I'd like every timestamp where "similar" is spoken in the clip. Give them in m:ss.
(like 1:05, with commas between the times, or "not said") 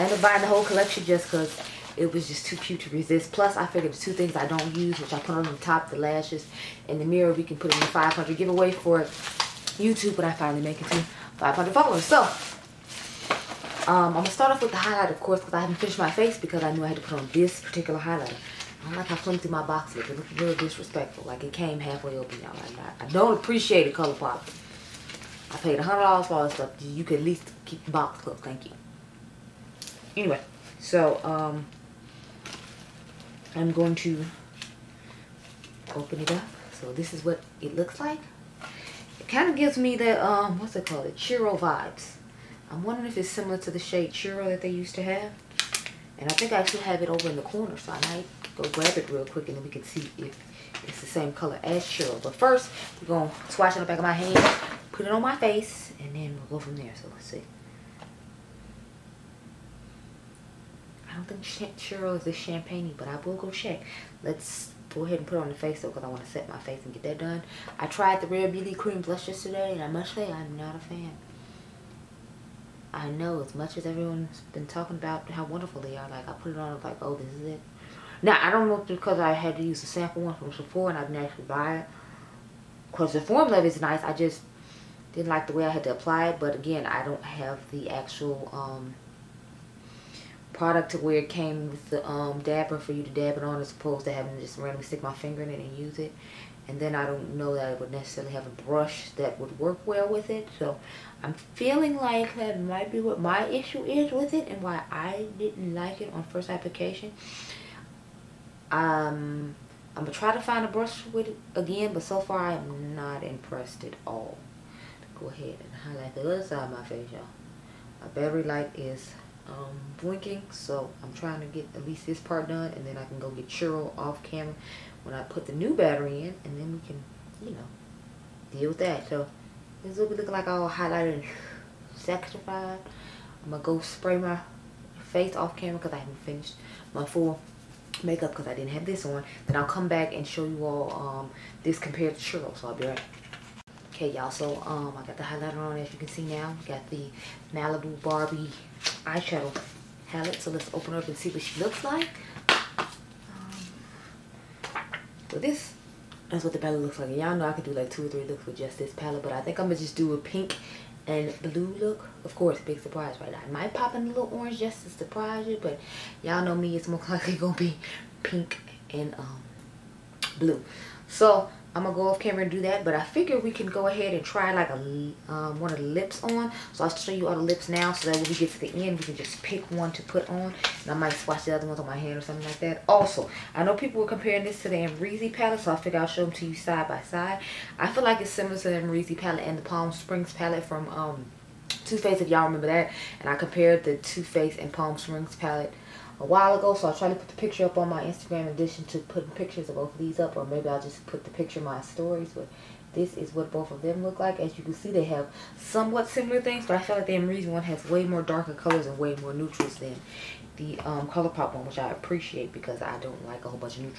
0:43, 3:08, 3:26.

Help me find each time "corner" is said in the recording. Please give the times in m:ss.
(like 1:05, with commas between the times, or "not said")
0:47.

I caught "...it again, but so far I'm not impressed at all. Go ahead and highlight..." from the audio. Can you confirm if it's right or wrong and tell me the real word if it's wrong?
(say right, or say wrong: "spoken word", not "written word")
right.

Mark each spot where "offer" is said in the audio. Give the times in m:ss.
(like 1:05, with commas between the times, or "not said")
not said.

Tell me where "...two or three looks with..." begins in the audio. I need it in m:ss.
2:37.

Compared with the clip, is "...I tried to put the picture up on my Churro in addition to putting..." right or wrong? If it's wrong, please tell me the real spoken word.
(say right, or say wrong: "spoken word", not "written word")
wrong: "Instagram", not "Churro".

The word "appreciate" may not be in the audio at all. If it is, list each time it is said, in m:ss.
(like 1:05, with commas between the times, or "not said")
0:23, 3:31.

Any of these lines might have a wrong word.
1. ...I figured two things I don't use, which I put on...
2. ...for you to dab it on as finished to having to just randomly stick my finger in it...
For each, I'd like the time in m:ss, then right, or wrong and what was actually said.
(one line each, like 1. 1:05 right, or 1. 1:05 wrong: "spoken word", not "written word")
1. 0:03 right
2. 1:32 wrong: "opposed", not "finished".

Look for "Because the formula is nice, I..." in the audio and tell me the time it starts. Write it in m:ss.
1:22.